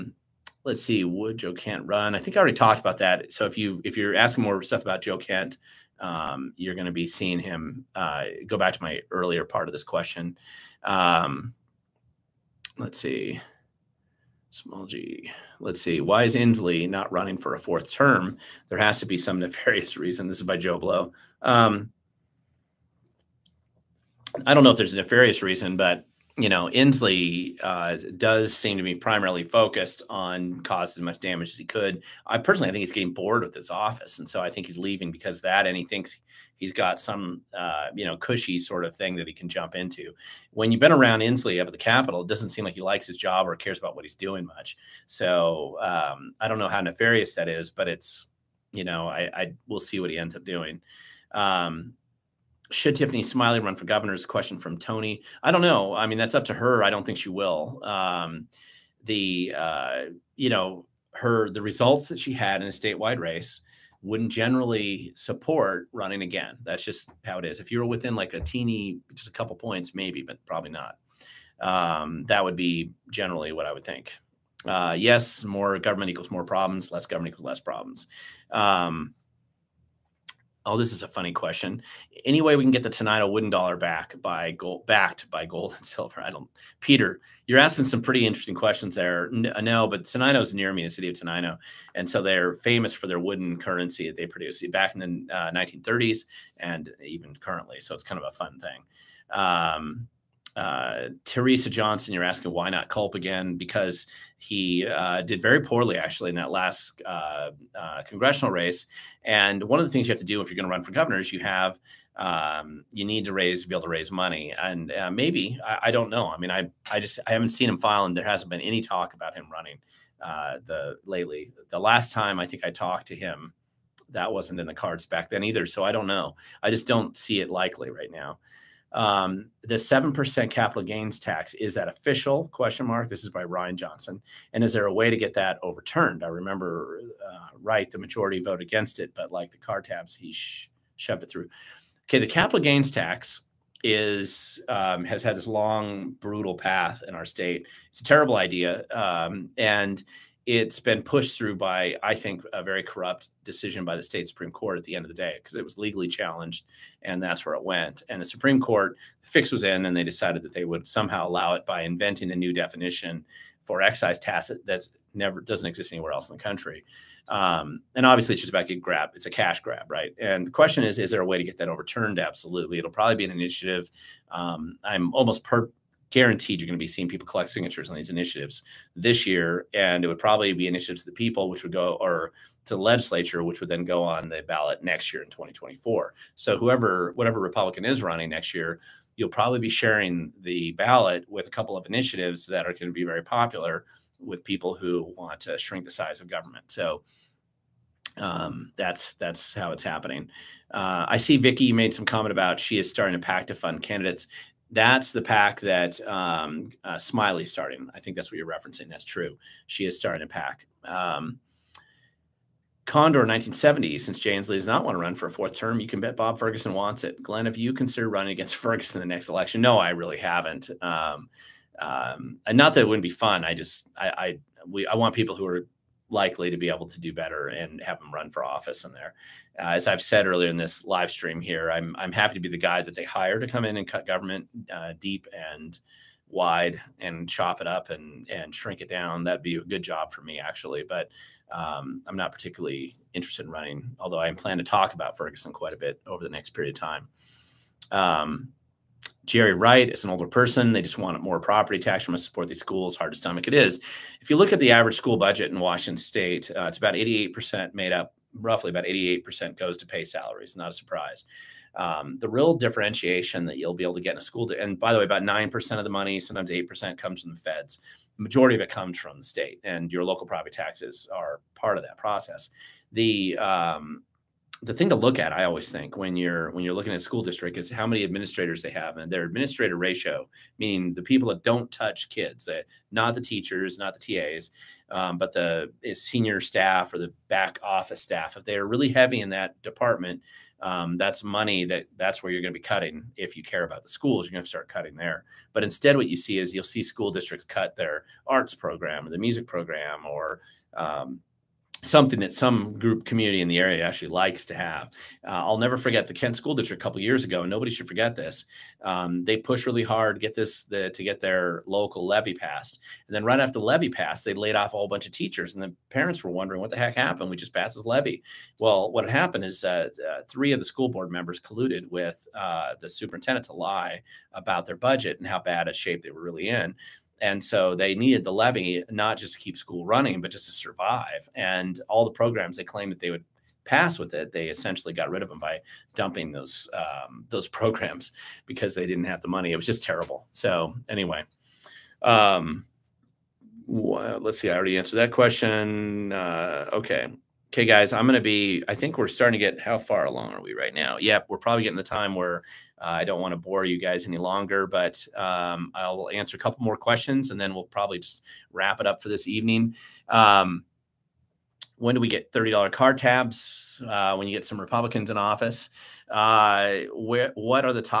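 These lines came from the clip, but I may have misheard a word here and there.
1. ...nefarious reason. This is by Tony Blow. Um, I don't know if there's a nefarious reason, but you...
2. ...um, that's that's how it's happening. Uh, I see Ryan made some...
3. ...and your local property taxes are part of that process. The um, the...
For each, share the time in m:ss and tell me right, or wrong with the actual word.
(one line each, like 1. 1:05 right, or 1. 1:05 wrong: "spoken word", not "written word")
1. 0:19 wrong: "Joe", not "Tony"
2. 3:18 wrong: "Vicky", not "Ryan"
3. 4:29 right.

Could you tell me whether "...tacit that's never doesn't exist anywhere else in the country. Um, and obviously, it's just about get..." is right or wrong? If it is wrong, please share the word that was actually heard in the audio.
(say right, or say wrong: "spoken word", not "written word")
right.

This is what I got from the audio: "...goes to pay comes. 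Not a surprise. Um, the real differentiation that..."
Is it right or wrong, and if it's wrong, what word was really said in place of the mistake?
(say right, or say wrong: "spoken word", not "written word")
wrong: "salaries", not "comes".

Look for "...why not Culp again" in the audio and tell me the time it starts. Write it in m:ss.
1:42.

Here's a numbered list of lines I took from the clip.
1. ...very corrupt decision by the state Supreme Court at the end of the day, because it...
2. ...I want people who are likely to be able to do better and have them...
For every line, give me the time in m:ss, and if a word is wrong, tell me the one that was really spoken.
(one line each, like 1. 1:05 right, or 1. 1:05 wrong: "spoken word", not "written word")
1. 2:32 right
2. 3:44 right.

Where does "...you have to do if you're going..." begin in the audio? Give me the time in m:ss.
1:50.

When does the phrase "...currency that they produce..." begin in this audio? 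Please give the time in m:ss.
1:33.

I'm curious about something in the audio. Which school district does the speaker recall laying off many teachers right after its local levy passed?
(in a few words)
Kent School District.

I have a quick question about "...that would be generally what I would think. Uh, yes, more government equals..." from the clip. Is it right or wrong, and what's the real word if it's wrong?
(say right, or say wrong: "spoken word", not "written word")
right.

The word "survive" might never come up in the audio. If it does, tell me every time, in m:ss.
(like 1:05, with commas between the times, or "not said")
5:30.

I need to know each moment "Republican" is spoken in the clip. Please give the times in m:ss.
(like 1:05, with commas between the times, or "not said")
3:07, 6:04.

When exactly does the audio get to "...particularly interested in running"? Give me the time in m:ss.
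4:02.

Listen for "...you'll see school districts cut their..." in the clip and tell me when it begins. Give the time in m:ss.
4:56.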